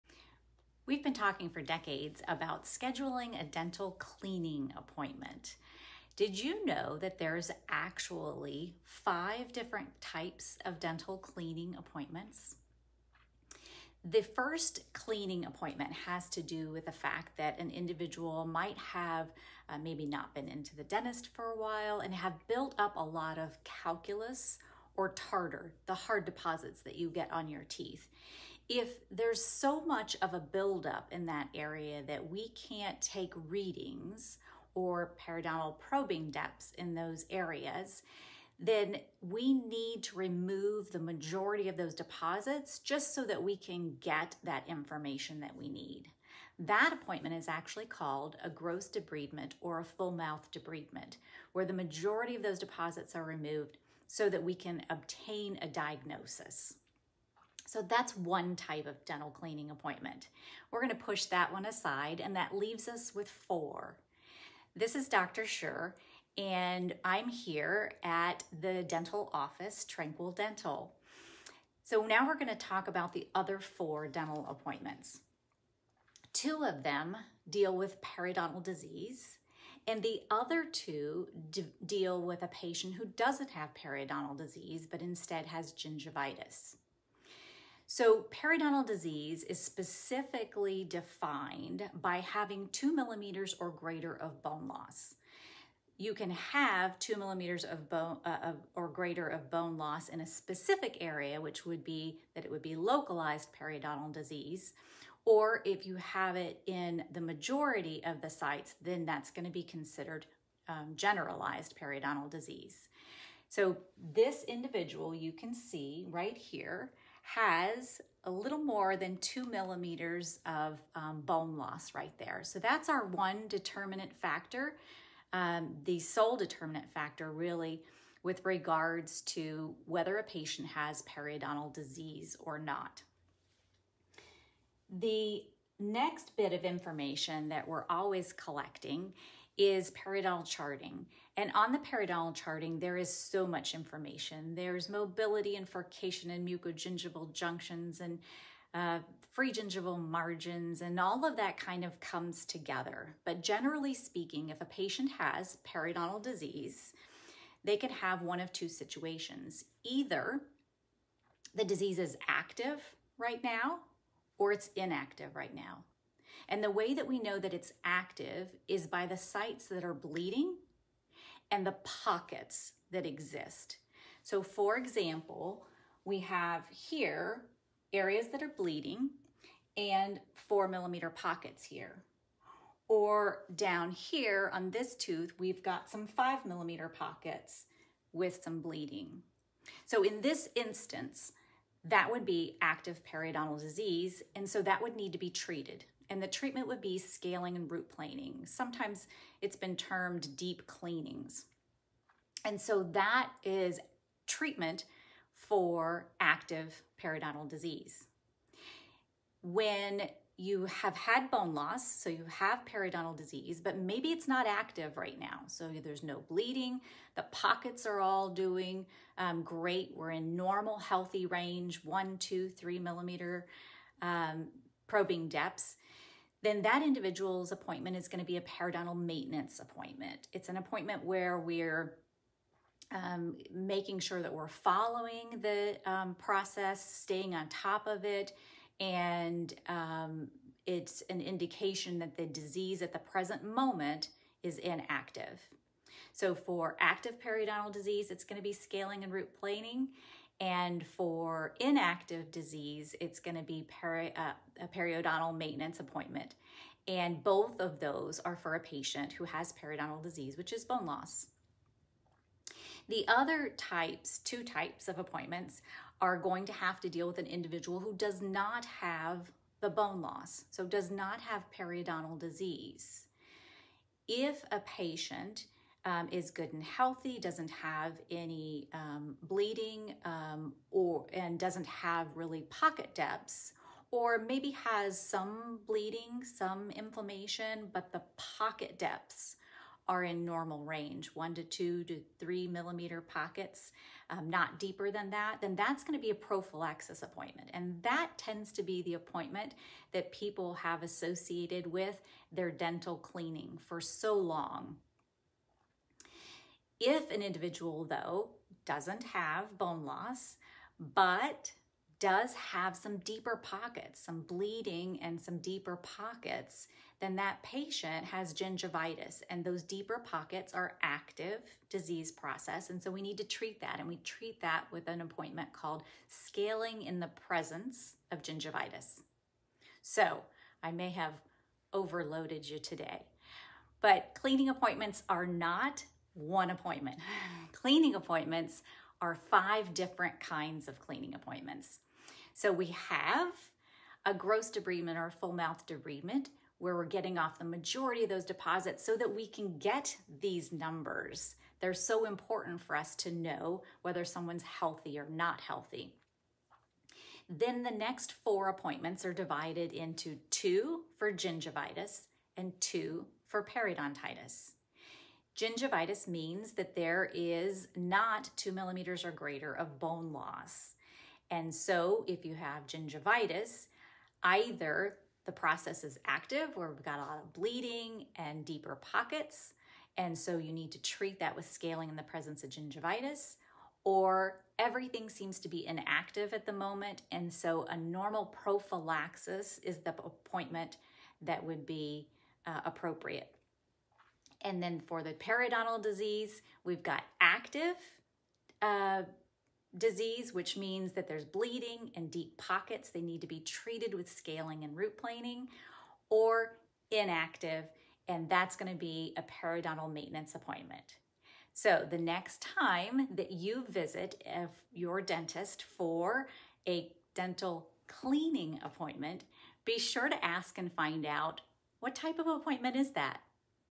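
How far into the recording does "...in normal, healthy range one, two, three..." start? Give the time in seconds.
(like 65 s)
220 s.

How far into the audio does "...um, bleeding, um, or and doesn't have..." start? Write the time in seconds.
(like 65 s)
278 s.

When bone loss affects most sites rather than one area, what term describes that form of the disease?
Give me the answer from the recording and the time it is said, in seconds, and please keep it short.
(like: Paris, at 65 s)
generalized periodontal disease, at 110 s.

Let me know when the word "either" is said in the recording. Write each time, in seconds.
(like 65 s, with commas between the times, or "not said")
159 s, 374 s.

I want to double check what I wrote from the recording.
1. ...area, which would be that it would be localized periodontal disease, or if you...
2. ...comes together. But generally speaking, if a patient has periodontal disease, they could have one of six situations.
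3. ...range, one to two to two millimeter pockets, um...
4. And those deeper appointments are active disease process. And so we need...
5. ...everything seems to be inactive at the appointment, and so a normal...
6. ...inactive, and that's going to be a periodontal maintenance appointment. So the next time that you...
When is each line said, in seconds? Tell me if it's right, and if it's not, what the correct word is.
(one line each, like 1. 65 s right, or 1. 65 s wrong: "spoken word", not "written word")
1. 101 s right
2. 151 s wrong: "two", not "six"
3. 290 s wrong: "three", not "two"
4. 319 s wrong: "pockets", not "appointments"
5. 384 s wrong: "moment", not "appointment"
6. 406 s right.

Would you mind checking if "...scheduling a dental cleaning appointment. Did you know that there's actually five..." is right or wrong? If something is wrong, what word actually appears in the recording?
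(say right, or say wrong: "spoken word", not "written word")
right.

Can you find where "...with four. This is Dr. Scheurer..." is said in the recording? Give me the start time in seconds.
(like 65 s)
63 s.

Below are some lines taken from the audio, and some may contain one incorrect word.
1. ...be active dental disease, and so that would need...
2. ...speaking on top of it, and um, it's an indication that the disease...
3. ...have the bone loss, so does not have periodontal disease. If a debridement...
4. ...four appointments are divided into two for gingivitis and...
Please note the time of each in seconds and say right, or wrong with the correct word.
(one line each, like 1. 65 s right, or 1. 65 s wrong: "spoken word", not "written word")
1. 192 s wrong: "periodontal", not "dental"
2. 236 s wrong: "staying", not "speaking"
3. 268 s wrong: "patient", not "debridement"
4. 358 s right.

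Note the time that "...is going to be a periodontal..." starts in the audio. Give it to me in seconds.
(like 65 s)
227 s.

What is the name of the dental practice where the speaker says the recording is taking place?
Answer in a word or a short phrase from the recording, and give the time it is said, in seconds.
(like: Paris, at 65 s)
Tranquil Dental, at 69 s.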